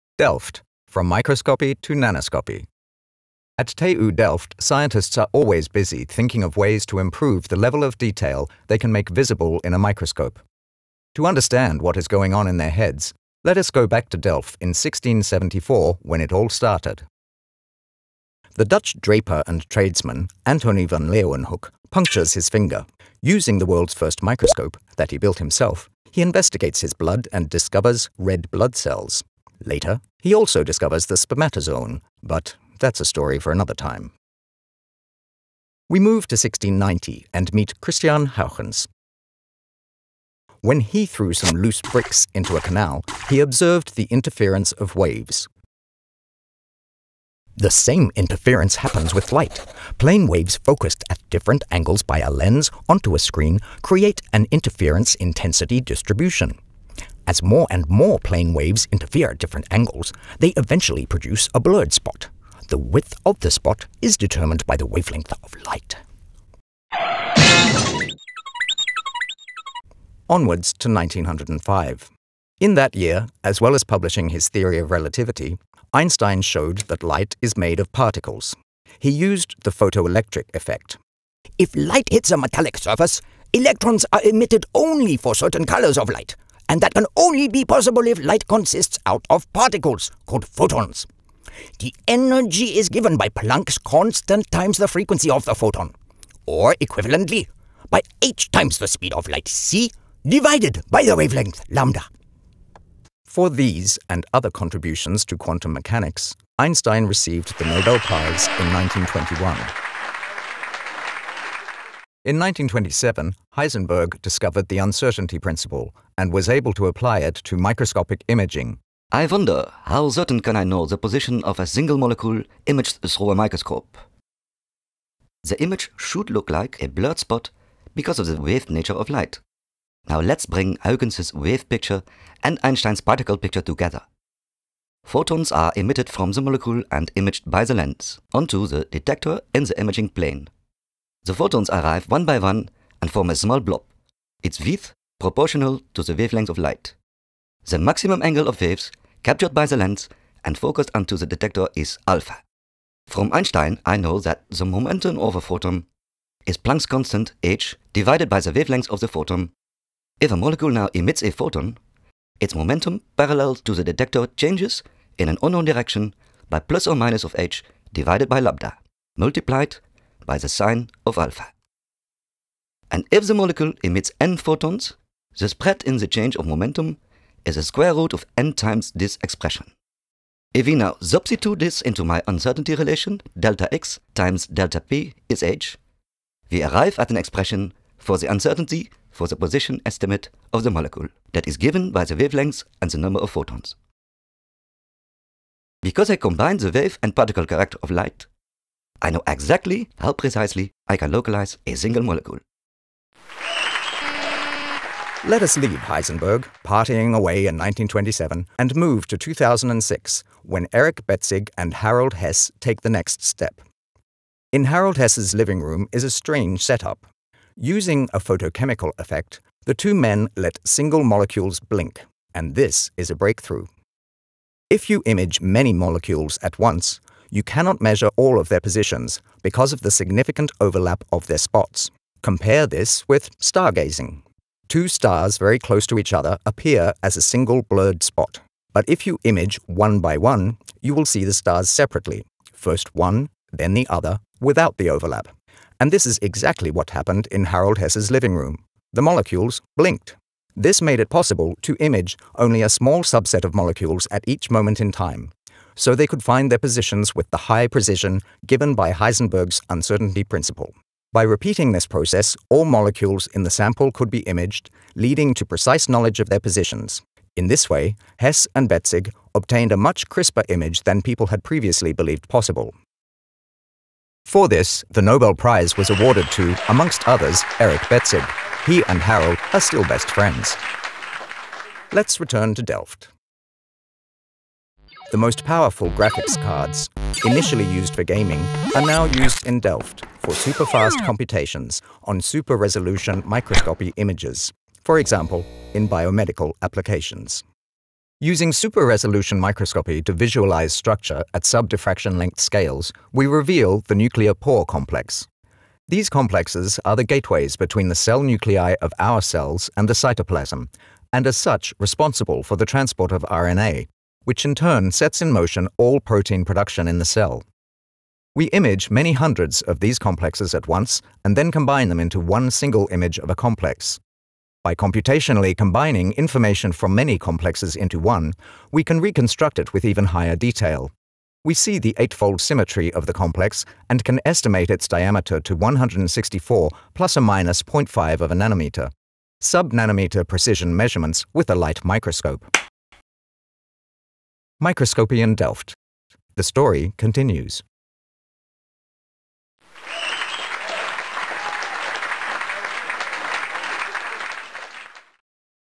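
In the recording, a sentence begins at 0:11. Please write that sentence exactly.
To understand what is going on in their heads, let us go back to Delft in 1674 when it all started.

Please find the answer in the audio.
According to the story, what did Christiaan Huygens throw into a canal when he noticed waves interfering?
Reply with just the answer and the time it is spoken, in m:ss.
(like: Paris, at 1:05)
loose bricks, at 0:41.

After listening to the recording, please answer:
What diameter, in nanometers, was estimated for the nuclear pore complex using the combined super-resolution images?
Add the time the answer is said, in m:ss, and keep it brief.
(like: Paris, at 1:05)
164, at 5:35.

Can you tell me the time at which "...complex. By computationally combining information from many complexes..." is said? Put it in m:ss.
5:23.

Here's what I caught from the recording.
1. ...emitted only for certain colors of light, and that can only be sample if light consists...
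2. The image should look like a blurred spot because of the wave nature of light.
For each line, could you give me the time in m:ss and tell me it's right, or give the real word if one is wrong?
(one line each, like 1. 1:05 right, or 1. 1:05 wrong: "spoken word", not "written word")
1. 1:24 wrong: "possible", not "sample"
2. 2:05 right.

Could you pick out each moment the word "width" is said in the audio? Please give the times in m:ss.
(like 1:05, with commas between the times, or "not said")
1:02, 2:24.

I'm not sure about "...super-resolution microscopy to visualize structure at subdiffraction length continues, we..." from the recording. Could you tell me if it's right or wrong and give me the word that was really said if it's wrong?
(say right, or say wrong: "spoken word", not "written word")
wrong: "scales", not "continues".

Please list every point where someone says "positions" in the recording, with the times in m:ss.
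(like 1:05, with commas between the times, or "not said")
2:00, 3:09, 3:48, 4:16, 4:26.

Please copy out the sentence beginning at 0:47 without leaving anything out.
The same interference happens with light.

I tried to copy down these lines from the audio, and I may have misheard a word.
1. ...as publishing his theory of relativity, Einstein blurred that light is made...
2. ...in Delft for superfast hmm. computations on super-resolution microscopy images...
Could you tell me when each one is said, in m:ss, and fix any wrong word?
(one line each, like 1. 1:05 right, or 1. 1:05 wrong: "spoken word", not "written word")
1. 1:13 wrong: "showed", not "blurred"
2. 4:49 right.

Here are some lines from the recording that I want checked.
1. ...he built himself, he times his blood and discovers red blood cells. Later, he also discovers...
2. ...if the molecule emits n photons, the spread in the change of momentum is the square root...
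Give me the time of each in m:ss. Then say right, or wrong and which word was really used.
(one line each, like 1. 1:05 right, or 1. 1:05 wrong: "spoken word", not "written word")
1. 0:25 wrong: "investigates", not "times"
2. 2:53 right.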